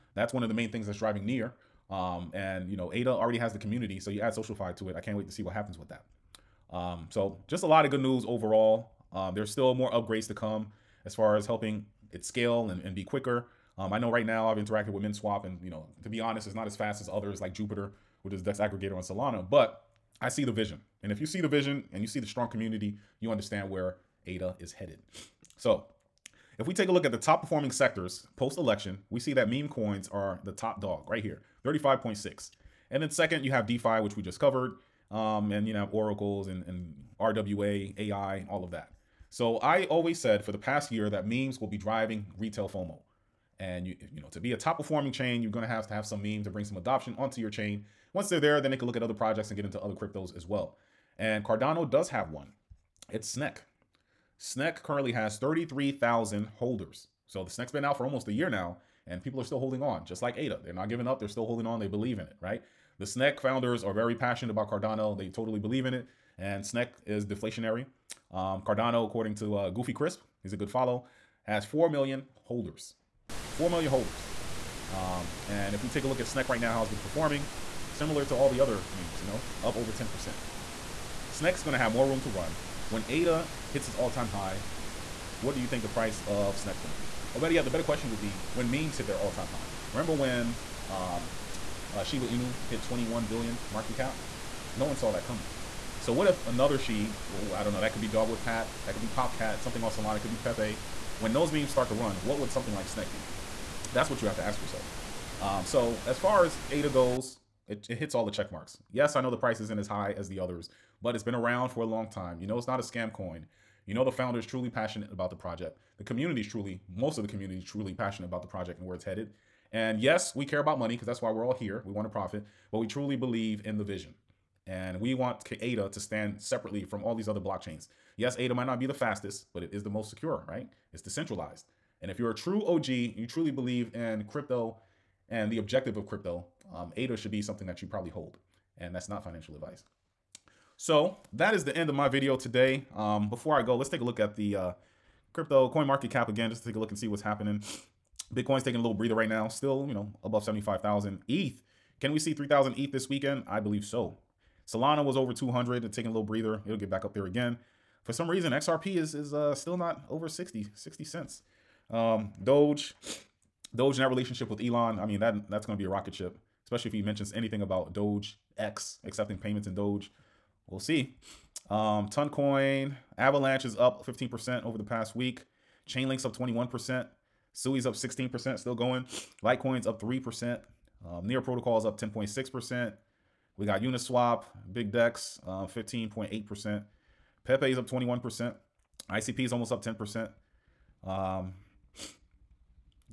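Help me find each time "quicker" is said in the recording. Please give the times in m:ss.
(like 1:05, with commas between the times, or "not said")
0:13.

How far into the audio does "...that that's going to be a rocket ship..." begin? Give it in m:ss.
2:45.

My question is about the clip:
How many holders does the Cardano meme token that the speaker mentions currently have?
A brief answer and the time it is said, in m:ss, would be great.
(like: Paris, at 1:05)
33,000, at 0:55.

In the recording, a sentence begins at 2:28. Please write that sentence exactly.
Bitcoin's taking a little breather right now, still, you know, above 75,000.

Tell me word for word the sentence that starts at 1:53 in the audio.
You know the founder is truly passionate about the project.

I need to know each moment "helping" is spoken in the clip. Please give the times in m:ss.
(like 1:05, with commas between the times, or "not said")
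0:11.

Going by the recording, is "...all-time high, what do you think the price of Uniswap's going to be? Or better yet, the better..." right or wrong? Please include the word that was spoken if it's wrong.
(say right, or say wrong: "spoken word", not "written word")
wrong: "Snack", not "Uniswap".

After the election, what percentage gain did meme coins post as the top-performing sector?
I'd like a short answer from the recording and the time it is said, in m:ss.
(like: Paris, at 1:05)
35.6, at 0:31.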